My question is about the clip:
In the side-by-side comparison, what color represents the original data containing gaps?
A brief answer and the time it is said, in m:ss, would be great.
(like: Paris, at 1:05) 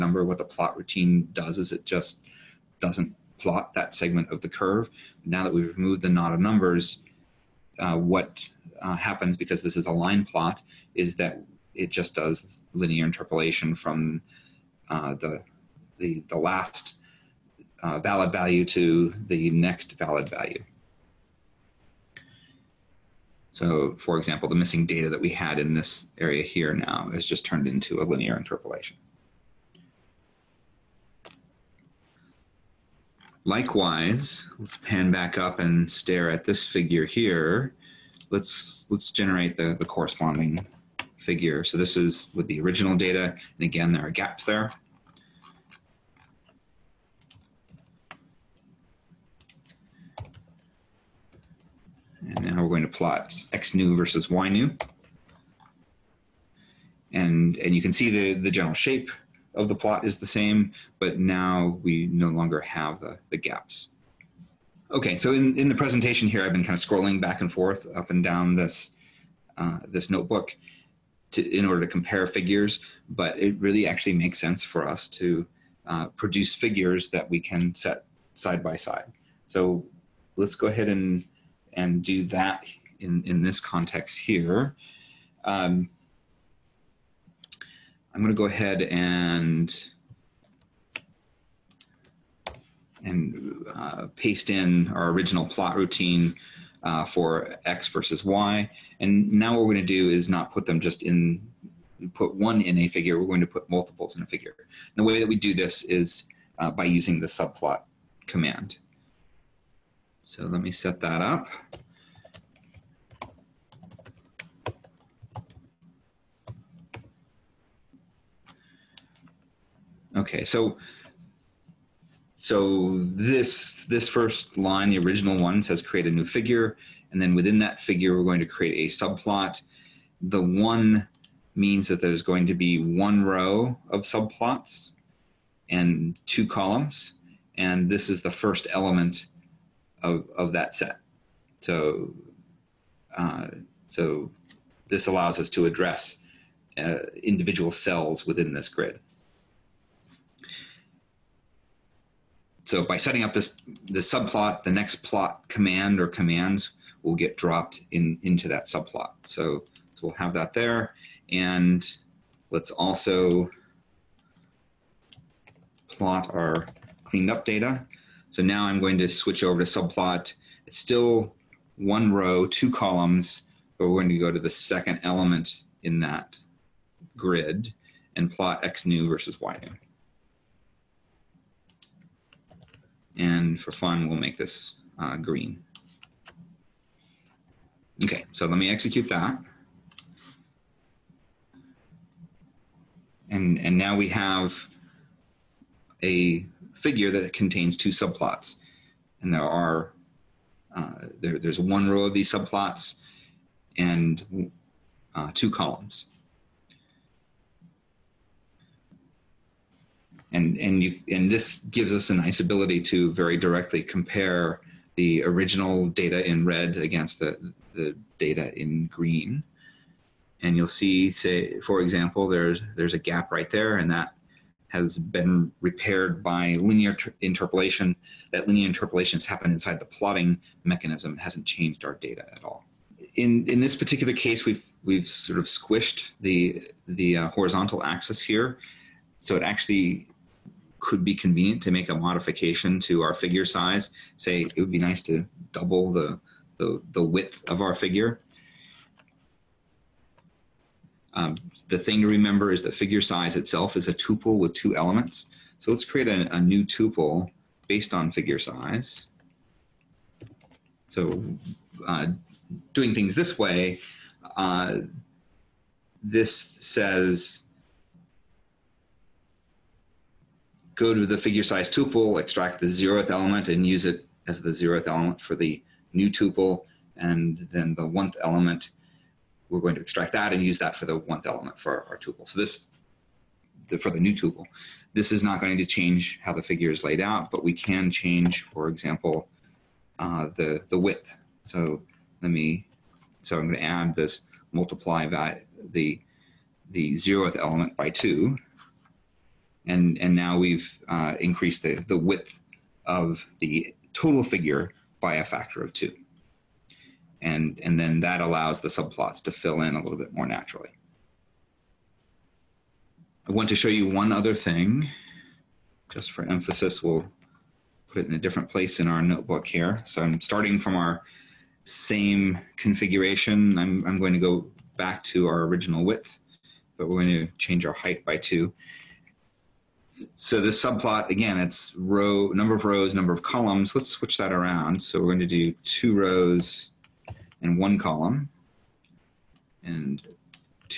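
red, at 3:36.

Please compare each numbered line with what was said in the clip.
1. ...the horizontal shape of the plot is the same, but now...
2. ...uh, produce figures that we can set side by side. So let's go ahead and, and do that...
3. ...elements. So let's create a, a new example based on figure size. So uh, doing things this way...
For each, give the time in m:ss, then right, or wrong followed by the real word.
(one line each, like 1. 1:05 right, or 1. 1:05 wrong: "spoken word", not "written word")
1. 0:58 wrong: "general", not "horizontal"
2. 1:15 right
3. 4:14 wrong: "tuple", not "example".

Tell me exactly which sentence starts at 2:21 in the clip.
So uh, so this allows us to address uh, individual cells within this grid.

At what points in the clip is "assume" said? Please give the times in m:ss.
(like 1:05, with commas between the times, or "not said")
not said.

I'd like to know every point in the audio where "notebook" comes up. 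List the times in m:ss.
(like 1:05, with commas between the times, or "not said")
1:10, 5:19.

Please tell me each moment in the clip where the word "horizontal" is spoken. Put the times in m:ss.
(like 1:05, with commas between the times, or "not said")
3:57.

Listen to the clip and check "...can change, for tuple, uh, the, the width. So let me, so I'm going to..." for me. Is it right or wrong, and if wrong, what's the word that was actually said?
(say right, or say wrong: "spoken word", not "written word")
wrong: "example", not "tuple".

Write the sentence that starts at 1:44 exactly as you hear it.
And the way that we do this is uh, by using the subplot command.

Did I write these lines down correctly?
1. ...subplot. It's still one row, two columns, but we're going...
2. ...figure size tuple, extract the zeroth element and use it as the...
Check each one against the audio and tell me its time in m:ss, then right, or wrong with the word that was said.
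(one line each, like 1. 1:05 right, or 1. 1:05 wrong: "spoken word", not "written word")
1. 2:49 right
2. 4:31 right.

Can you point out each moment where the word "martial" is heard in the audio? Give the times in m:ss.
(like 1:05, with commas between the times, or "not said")
not said.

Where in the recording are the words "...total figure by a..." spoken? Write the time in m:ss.
5:03.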